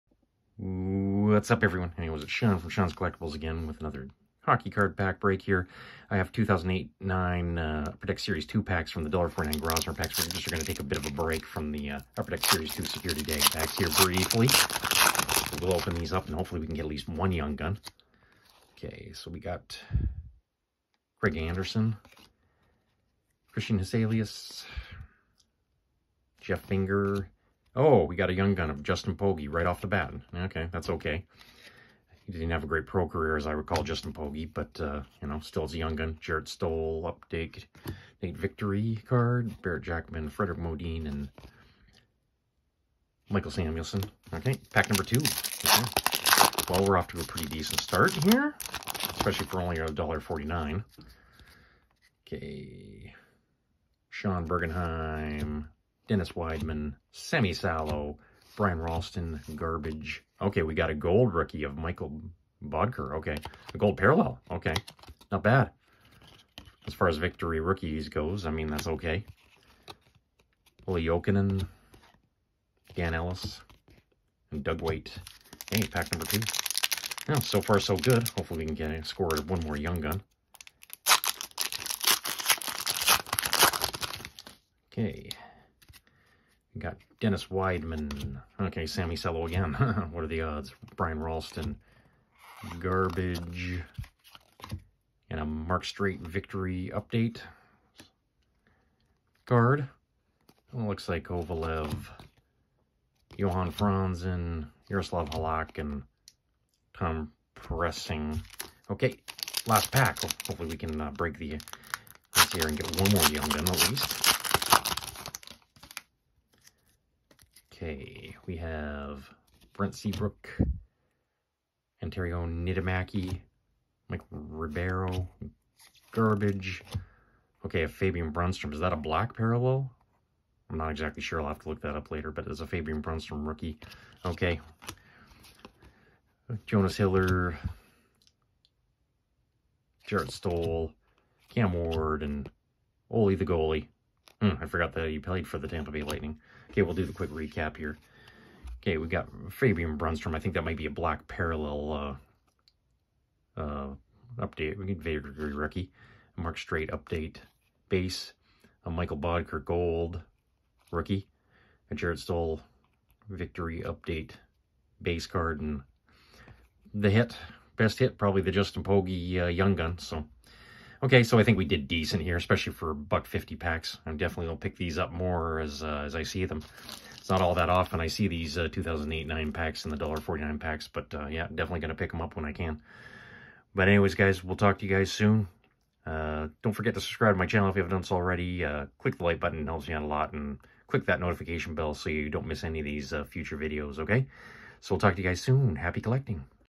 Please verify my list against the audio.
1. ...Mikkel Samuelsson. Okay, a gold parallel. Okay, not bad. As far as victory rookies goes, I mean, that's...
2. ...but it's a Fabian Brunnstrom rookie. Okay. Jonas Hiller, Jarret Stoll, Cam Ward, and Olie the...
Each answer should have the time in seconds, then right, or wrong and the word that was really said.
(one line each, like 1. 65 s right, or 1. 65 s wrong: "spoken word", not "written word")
1. 61 s wrong: "Boedker", not "Samuelsson"
2. 132 s right.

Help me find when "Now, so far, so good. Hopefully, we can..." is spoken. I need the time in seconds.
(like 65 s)
77 s.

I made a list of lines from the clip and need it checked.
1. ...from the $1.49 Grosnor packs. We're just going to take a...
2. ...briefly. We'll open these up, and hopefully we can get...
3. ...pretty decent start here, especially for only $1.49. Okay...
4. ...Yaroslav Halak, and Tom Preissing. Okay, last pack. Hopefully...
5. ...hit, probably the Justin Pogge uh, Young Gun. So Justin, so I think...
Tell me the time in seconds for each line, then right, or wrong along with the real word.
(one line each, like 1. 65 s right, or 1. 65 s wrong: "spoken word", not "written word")
1. 8 s right
2. 14 s right
3. 47 s right
4. 104 s right
5. 167 s wrong: "Okay", not "Justin".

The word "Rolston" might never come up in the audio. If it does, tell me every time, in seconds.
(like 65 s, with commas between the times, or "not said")
58 s, 91 s.